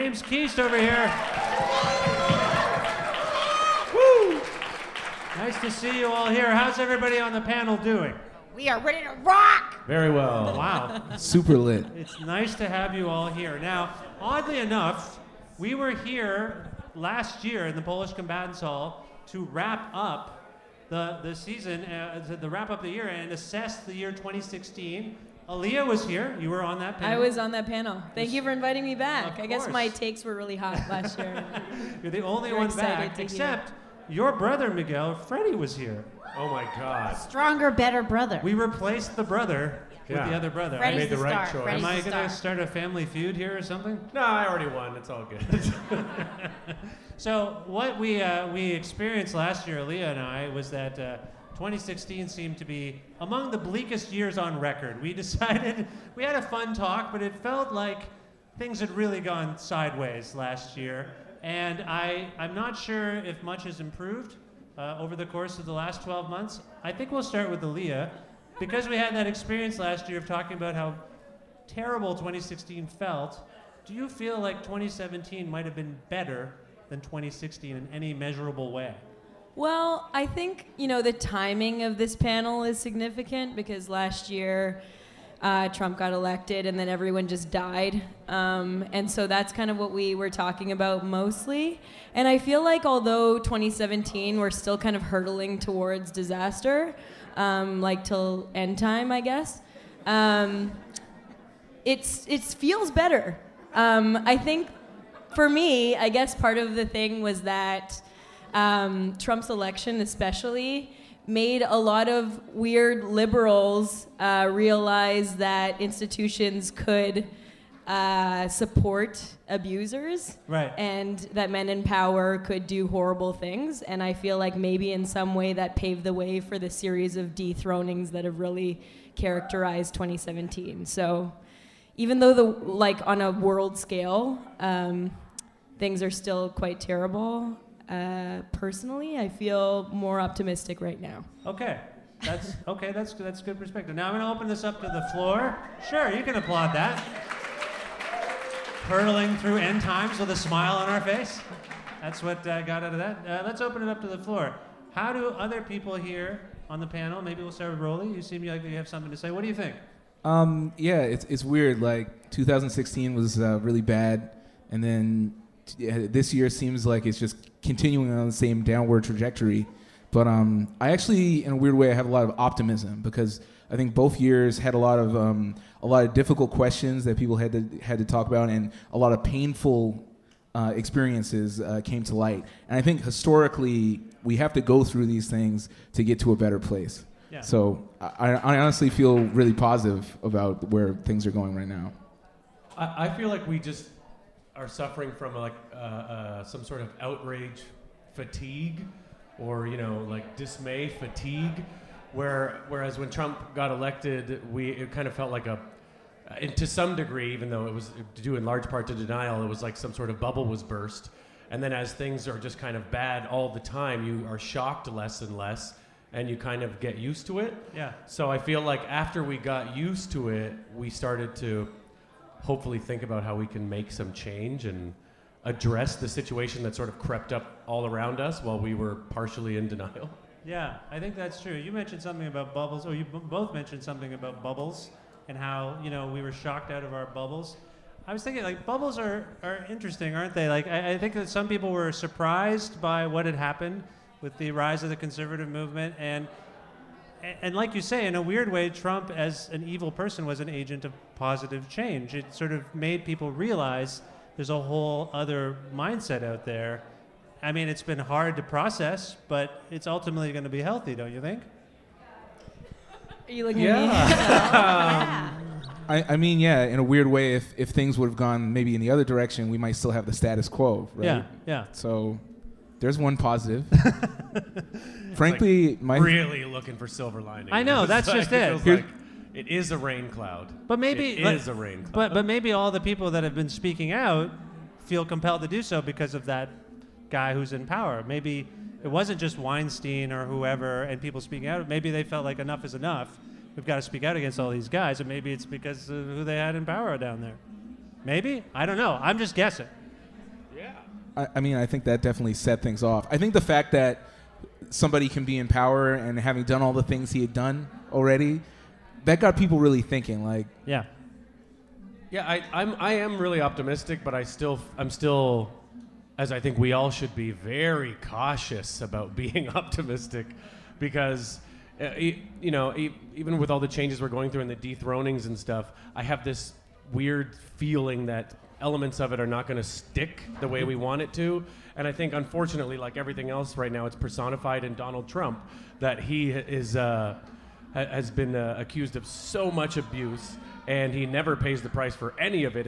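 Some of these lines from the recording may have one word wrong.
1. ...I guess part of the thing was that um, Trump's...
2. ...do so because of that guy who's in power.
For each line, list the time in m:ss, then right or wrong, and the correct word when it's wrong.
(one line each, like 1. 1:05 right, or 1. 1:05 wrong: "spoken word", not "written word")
1. 1:45 right
2. 4:45 right.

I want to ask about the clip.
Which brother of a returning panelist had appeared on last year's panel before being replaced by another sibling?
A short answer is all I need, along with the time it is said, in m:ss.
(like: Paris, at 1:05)
Miguel, at 0:34.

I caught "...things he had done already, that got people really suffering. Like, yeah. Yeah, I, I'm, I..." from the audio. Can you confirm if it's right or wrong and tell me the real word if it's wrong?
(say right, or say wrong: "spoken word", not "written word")
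wrong: "thinking", not "suffering".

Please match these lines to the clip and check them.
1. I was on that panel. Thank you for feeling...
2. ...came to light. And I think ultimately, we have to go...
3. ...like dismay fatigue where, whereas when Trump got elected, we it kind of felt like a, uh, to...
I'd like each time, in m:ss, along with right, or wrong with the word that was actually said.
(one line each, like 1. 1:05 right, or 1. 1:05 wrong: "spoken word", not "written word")
1. 0:27 wrong: "inviting", not "feeling"
2. 3:01 wrong: "historically", not "ultimately"
3. 3:20 right.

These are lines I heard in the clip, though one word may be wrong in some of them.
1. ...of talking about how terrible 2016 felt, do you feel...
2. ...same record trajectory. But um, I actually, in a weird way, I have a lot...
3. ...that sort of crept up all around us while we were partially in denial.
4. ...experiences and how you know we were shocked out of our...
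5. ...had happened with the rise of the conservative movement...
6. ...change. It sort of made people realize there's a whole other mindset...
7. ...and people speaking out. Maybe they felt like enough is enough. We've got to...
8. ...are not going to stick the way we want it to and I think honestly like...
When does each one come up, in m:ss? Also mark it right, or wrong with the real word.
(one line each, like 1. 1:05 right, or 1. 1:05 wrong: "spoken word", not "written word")
1. 1:10 right
2. 2:48 wrong: "downward", not "record"
3. 3:46 right
4. 3:54 wrong: "bubbles", not "experiences"
5. 4:03 right
6. 4:11 right
7. 4:50 right
8. 5:29 wrong: "unfortunately", not "honestly".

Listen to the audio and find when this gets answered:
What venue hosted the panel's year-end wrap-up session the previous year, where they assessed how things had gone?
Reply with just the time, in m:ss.
0:17.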